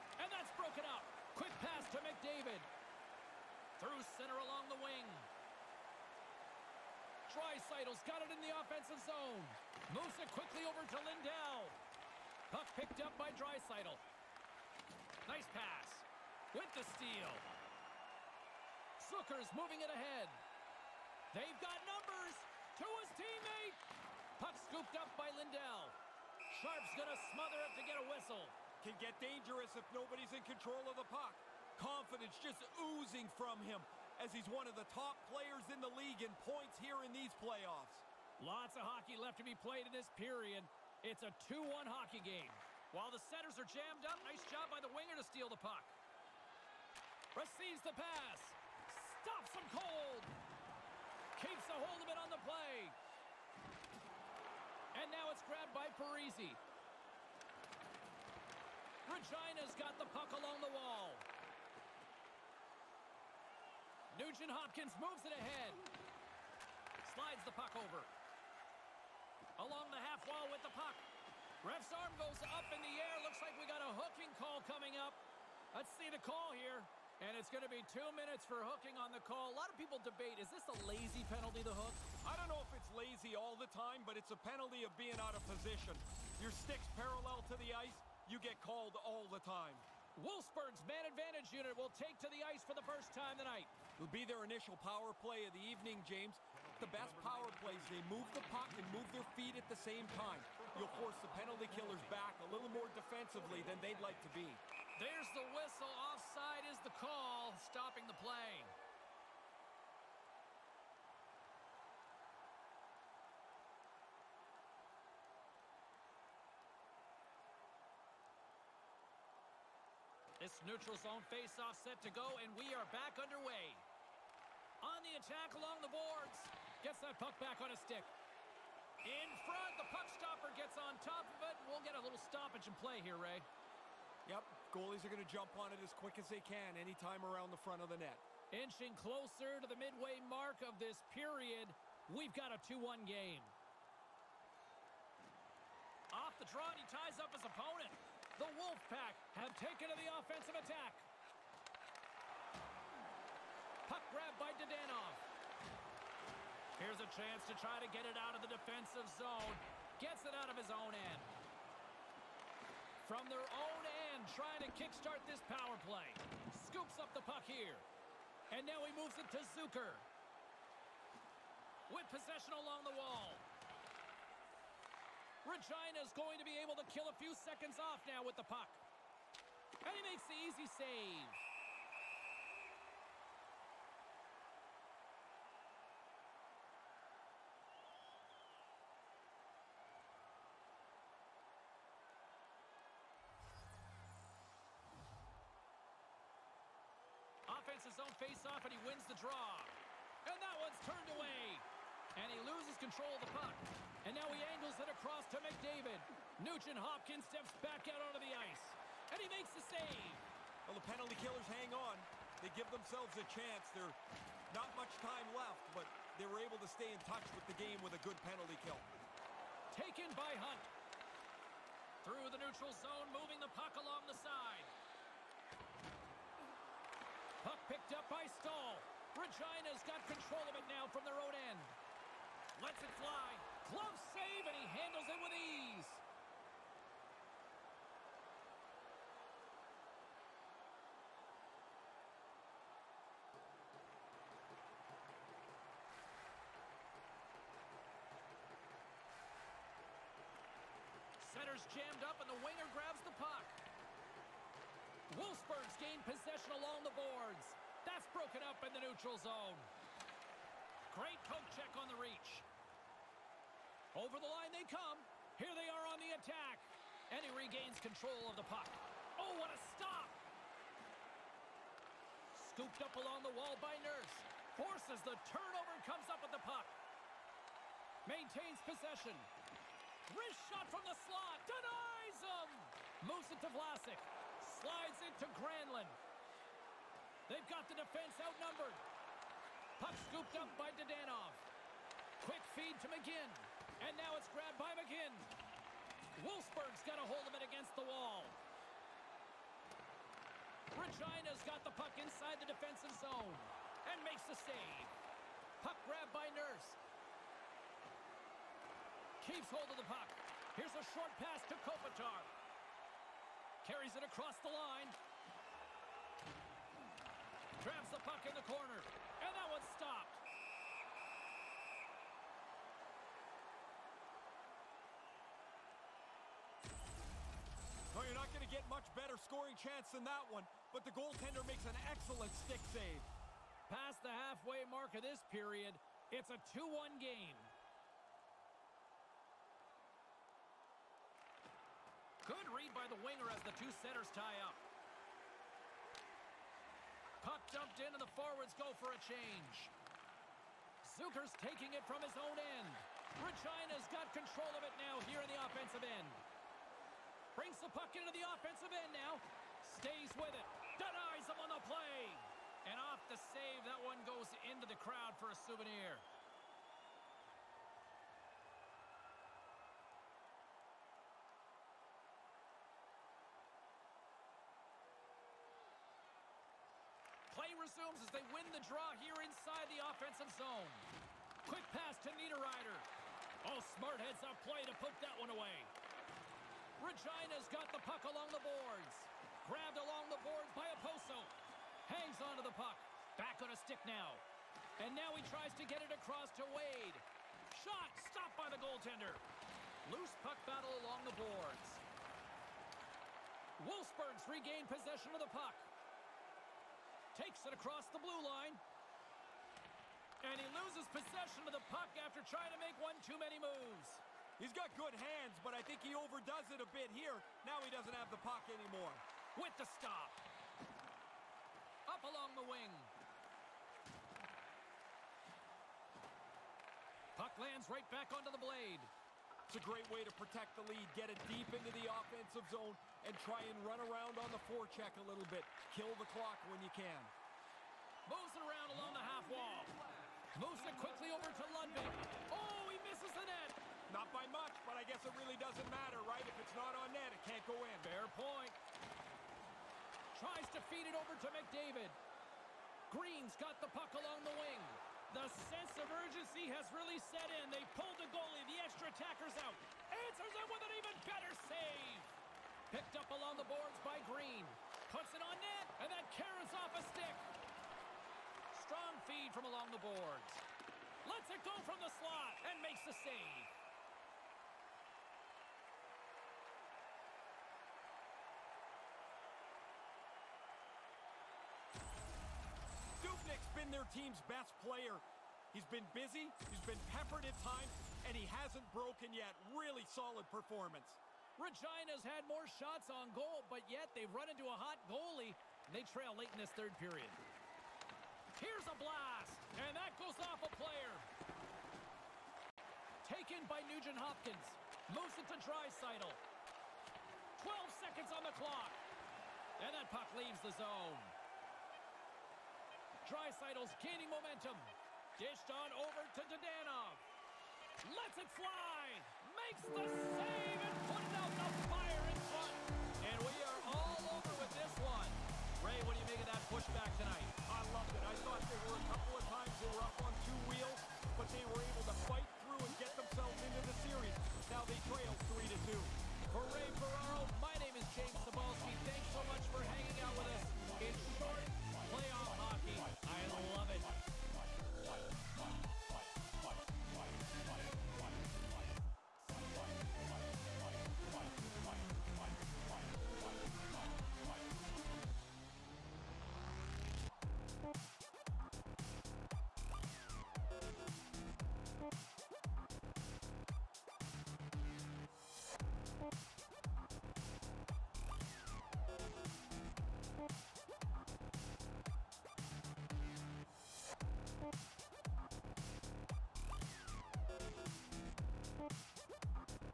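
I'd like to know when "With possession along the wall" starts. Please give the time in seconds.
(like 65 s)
171 s.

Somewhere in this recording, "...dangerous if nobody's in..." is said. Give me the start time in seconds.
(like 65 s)
29 s.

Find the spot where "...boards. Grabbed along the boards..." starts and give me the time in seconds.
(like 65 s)
388 s.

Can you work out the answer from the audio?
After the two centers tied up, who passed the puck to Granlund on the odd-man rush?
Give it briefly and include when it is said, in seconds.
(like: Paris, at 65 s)
Vlasic, at 283 s.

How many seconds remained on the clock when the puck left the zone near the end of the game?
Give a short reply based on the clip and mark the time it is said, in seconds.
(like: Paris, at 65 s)
12, at 507 s.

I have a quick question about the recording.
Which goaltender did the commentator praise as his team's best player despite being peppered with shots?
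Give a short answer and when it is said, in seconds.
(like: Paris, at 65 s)
Dubnyk, at 483 s.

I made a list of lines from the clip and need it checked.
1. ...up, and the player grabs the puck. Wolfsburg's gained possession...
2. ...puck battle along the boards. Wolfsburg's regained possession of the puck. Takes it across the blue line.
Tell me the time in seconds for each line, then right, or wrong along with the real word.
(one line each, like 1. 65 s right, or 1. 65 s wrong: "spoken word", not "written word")
1. 252 s wrong: "winger", not "player"
2. 400 s right.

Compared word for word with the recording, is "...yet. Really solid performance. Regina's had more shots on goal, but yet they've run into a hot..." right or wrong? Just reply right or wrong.
right.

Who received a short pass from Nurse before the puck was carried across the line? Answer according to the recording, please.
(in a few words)
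Kopitar.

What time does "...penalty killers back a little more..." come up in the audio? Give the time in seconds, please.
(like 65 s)
101 s.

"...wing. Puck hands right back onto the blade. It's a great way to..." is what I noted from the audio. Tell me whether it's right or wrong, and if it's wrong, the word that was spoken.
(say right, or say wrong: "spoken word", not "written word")
wrong: "lands", not "hands".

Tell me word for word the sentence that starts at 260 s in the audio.
Great poke check on the reach.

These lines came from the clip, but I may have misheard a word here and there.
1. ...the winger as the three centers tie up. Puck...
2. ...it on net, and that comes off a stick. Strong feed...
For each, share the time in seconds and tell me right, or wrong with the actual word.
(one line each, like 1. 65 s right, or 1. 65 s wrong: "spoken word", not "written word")
1. 342 s wrong: "two", not "three"
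2. 465 s wrong: "carries", not "comes".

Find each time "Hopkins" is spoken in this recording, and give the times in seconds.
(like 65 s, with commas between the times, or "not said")
64 s, 206 s, 503 s.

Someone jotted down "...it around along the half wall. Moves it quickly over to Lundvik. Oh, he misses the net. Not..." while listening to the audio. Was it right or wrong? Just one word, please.
right.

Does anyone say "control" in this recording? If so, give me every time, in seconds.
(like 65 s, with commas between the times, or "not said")
30 s, 202 s, 230 s, 267 s, 354 s.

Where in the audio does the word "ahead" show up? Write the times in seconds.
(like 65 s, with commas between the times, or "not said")
19 s, 65 s.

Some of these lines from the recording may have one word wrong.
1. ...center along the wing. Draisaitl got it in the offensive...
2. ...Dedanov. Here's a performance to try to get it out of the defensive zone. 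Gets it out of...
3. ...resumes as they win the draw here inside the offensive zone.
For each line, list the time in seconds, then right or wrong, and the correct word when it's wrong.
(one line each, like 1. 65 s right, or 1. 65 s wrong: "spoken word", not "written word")
1. 4 s right
2. 154 s wrong: "chance", not "performance"
3. 377 s right.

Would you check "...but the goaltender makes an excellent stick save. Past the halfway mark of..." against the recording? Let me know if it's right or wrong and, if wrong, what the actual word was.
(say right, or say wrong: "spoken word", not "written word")
right.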